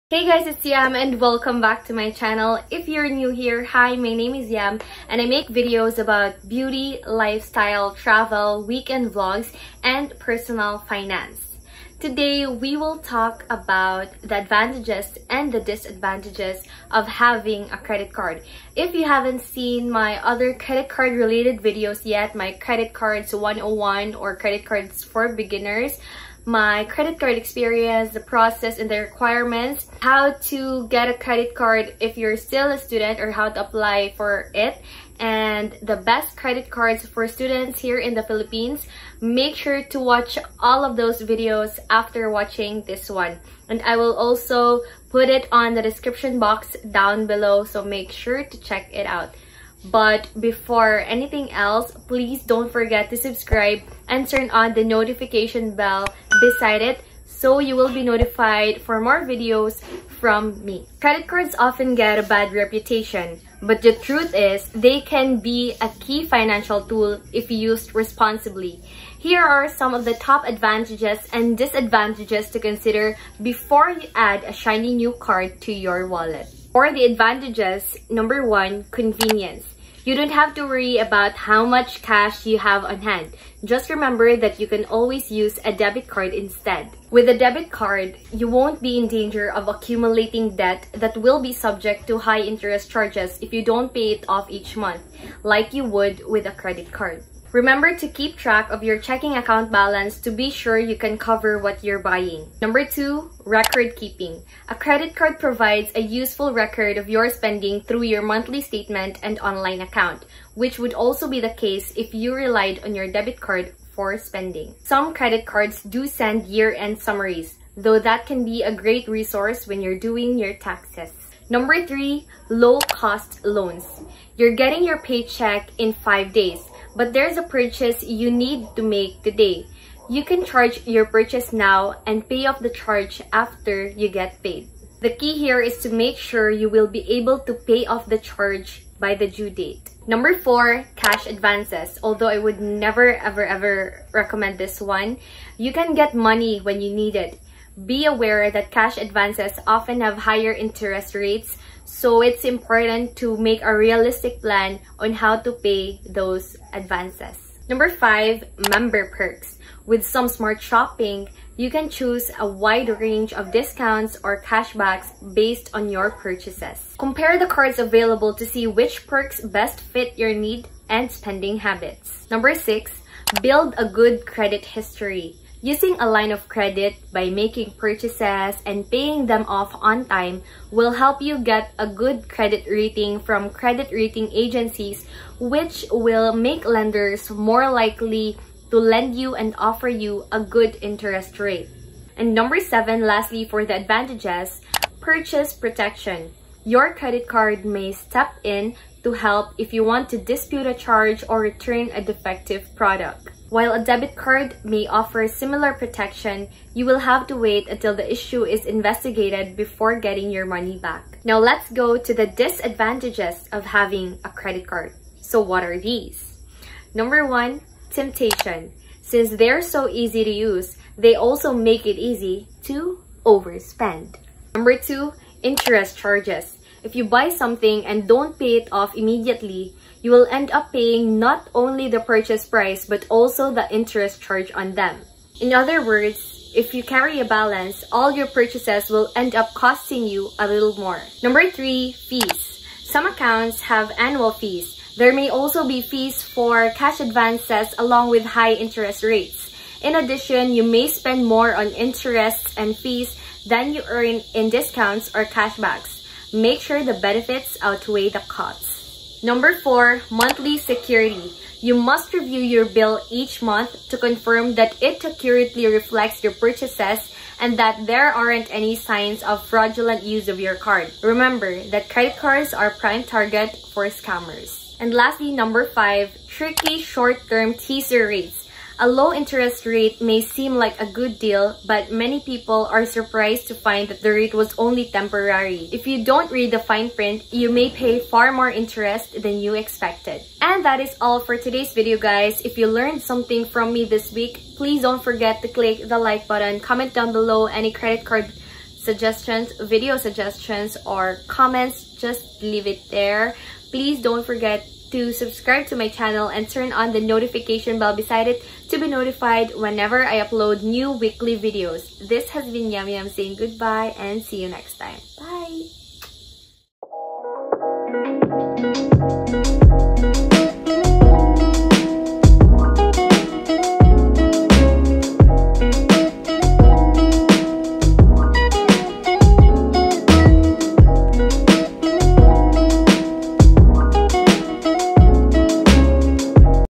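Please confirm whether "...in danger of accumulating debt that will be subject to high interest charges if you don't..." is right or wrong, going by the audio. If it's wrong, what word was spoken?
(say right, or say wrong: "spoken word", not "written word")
right.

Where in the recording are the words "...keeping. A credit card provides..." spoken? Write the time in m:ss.
1:43.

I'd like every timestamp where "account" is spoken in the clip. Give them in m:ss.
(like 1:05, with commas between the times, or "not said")
1:39, 1:49, 4:03.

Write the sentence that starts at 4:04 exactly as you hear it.
There may also be fees for cash advances along with high interest rates.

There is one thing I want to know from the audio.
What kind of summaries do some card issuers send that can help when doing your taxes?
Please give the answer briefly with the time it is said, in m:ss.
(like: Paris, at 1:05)
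Year-end summaries, at 1:56.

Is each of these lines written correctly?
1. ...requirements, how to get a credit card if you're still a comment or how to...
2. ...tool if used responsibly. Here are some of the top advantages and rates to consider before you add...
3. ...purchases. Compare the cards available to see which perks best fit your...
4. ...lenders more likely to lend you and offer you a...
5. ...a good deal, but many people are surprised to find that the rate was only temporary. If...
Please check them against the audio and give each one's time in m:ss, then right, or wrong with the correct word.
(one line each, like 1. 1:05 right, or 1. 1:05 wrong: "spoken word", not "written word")
1. 0:29 wrong: "student", not "comment"
2. 1:06 wrong: "disadvantages", not "rates"
3. 2:46 right
4. 3:06 right
5. 4:40 right.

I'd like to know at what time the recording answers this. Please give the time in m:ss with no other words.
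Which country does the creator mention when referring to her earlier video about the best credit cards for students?
0:38.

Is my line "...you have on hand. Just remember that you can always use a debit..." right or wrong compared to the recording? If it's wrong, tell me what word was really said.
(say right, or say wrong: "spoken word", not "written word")
right.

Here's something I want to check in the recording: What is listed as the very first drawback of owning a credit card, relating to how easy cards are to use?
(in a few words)
Temptation.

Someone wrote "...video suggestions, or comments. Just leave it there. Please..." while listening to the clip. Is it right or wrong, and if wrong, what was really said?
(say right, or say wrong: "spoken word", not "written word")
right.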